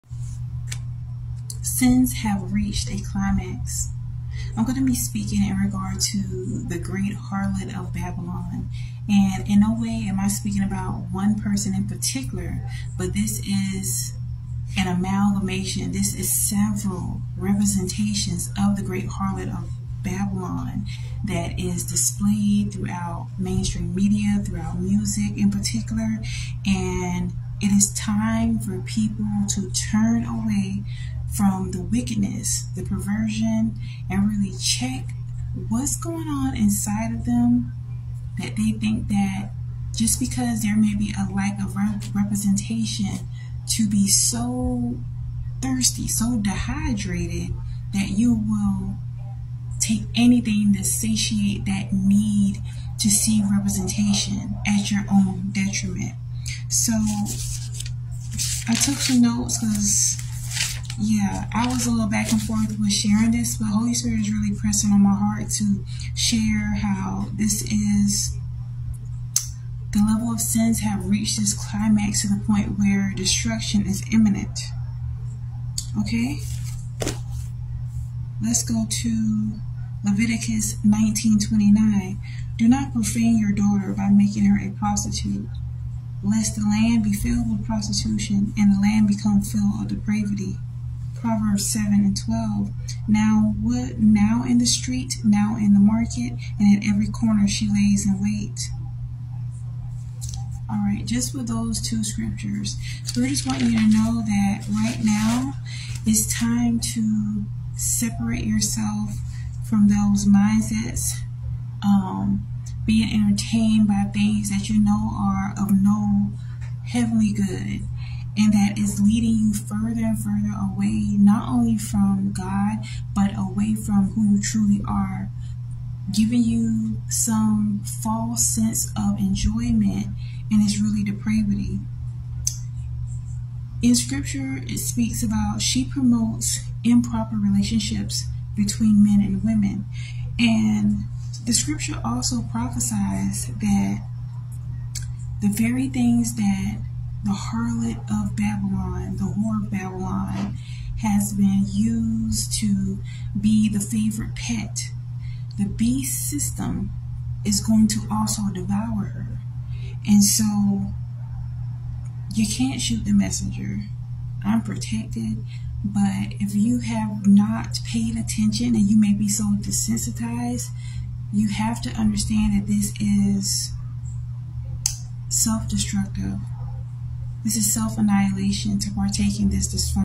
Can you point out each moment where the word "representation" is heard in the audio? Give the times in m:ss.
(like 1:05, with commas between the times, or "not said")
0:17, 0:42, 0:53.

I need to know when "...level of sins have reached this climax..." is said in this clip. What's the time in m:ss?
1:09.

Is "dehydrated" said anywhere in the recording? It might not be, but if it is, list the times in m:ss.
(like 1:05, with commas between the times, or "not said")
0:46.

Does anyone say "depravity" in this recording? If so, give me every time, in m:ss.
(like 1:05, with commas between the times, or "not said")
1:29, 2:11.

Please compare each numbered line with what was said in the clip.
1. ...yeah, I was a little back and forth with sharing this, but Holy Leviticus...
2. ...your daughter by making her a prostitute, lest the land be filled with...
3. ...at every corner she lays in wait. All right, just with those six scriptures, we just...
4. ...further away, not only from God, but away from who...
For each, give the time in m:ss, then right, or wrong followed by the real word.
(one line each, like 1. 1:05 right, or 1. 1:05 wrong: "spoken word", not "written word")
1. 1:01 wrong: "Spirit", not "Leviticus"
2. 1:23 right
3. 1:36 wrong: "two", not "six"
4. 2:00 right.